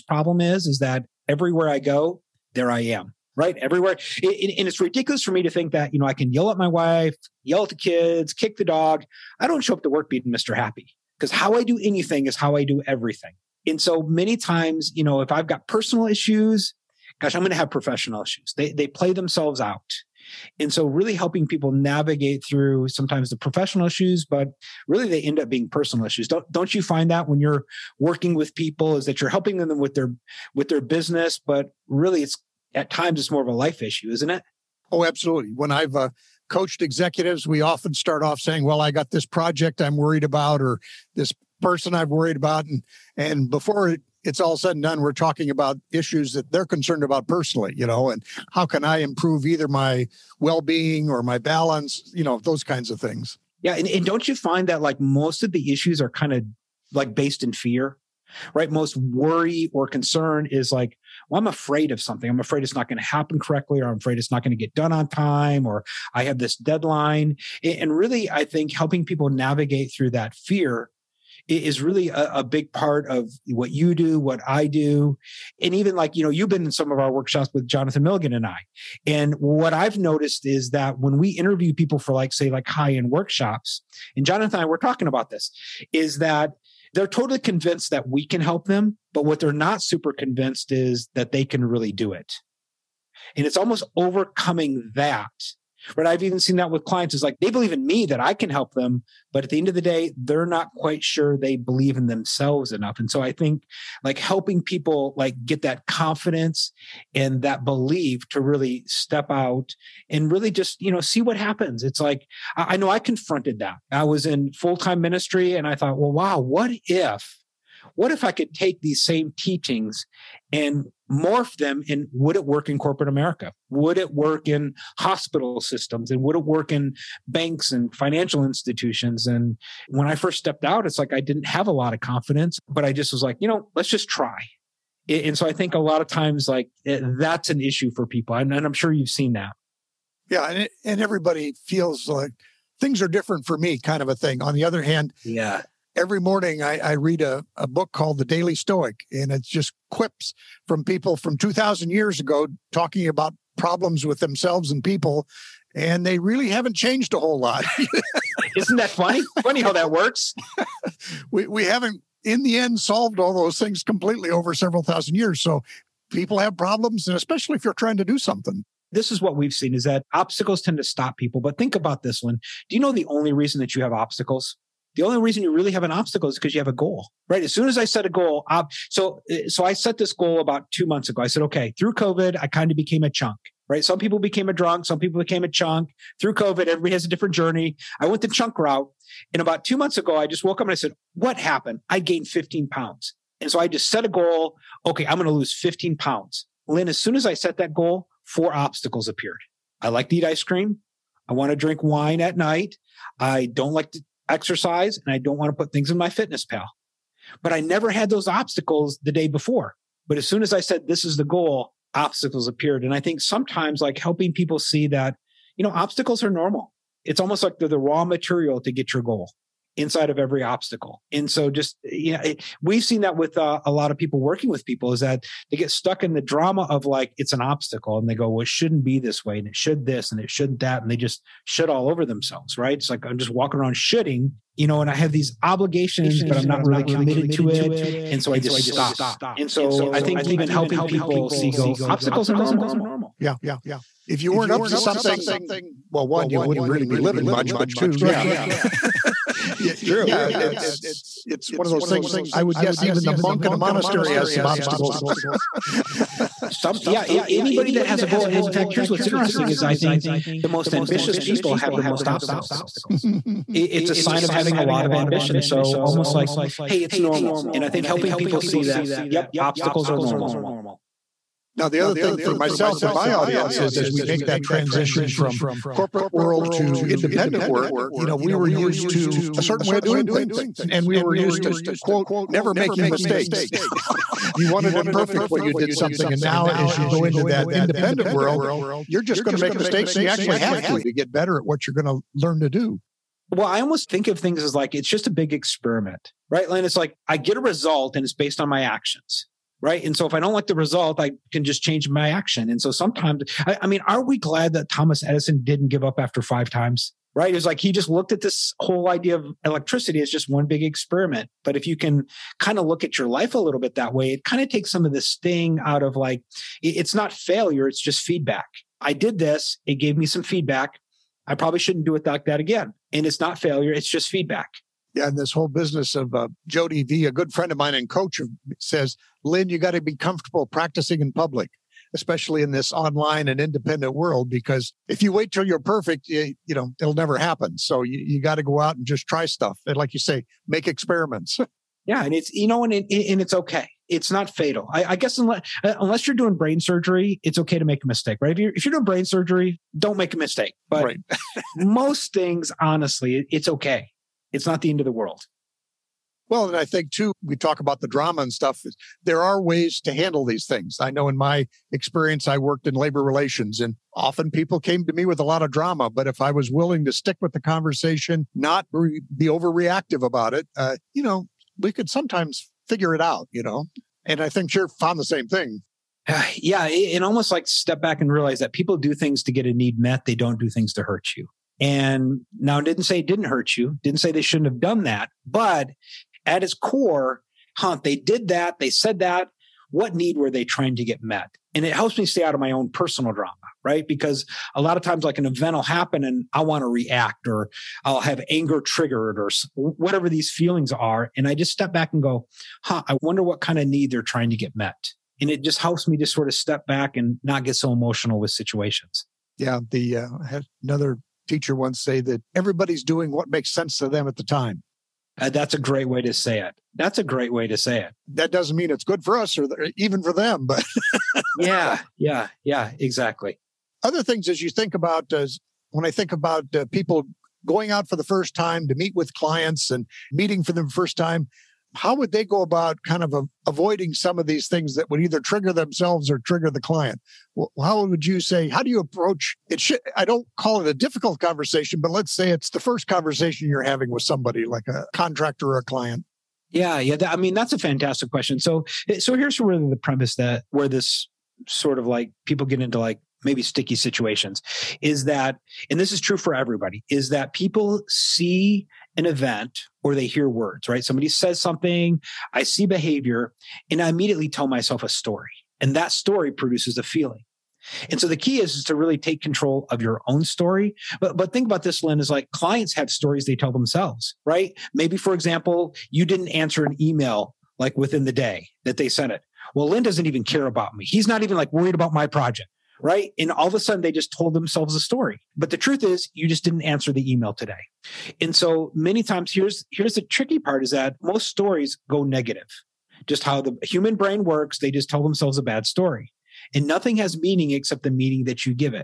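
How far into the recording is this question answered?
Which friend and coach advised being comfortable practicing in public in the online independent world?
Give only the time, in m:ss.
5:26.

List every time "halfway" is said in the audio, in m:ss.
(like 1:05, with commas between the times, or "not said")
not said.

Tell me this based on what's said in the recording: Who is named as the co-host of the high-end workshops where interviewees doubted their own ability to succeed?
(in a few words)
Jonathan Milligan.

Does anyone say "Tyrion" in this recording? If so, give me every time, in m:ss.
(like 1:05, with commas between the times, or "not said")
not said.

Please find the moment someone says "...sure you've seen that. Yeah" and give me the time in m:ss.
2:18.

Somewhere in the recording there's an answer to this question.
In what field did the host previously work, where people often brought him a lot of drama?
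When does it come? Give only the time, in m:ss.
6:02.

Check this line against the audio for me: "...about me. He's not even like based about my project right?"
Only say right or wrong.
wrong.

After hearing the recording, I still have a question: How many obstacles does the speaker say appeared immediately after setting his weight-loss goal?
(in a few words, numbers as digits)
4.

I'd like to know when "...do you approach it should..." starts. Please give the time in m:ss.
7:18.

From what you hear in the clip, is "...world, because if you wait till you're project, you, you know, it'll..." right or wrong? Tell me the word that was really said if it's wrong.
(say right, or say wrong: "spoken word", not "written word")
wrong: "perfect", not "project".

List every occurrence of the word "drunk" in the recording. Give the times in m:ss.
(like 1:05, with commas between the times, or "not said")
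3:04.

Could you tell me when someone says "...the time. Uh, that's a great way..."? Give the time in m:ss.
6:54.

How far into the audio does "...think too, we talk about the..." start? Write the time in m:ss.
5:56.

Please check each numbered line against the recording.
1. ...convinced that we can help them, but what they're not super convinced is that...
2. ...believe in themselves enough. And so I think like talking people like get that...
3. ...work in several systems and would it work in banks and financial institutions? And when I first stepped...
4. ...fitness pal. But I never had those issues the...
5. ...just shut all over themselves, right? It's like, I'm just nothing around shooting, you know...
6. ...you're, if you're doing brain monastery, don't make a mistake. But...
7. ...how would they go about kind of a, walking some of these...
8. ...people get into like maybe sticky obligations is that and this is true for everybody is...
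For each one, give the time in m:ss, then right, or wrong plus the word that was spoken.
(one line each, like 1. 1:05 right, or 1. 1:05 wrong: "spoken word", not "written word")
1. 1:27 right
2. 1:41 wrong: "helping", not "talking"
3. 2:04 wrong: "hospital", not "several"
4. 3:26 wrong: "obstacles", not "issues"
5. 3:50 wrong: "walking", not "nothing"
6. 5:48 wrong: "surgery", not "monastery"
7. 7:11 wrong: "avoiding", not "walking"
8. 7:32 wrong: "situations", not "obligations".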